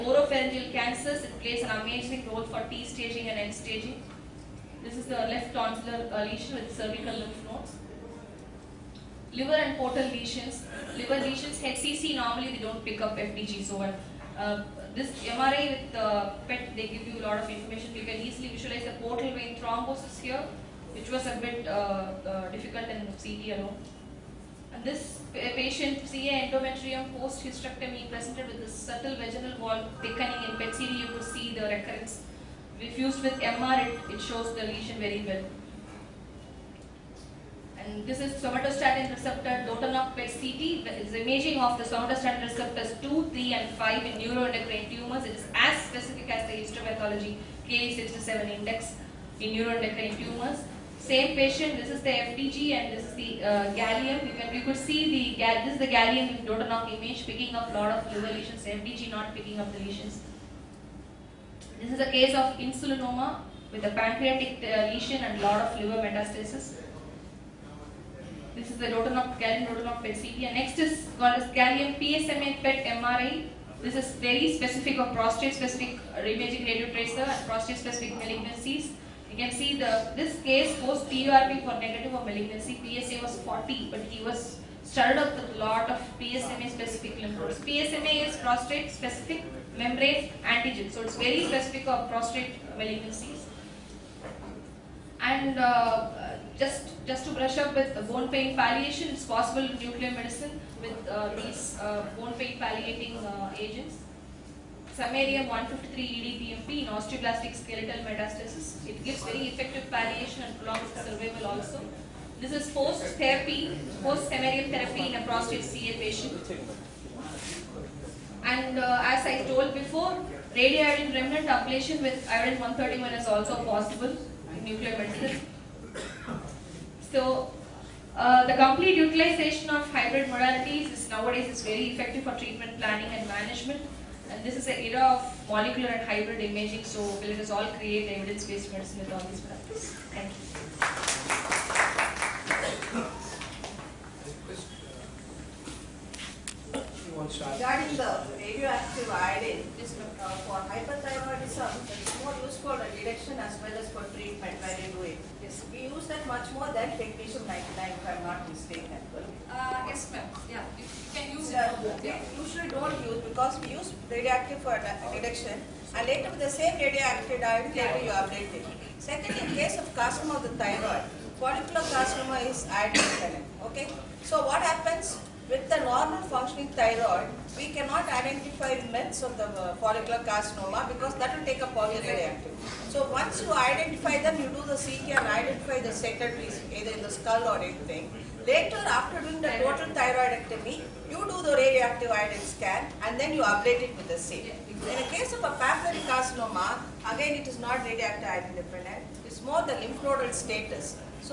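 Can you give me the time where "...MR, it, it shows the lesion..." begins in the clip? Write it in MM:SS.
00:33.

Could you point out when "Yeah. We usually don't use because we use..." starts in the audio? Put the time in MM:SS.
02:42.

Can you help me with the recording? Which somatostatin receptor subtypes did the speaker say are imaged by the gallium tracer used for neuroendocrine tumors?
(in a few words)
2, 3, and 5.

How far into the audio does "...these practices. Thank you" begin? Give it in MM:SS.
02:19.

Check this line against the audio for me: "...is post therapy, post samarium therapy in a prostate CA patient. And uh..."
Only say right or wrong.
right.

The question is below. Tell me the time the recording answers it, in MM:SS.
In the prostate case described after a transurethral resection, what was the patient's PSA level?
01:22.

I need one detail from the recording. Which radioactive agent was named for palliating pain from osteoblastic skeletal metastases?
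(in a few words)
Samarium 153 EDTMP.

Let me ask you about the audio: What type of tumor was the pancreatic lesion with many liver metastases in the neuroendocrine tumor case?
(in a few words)
Insulinoma.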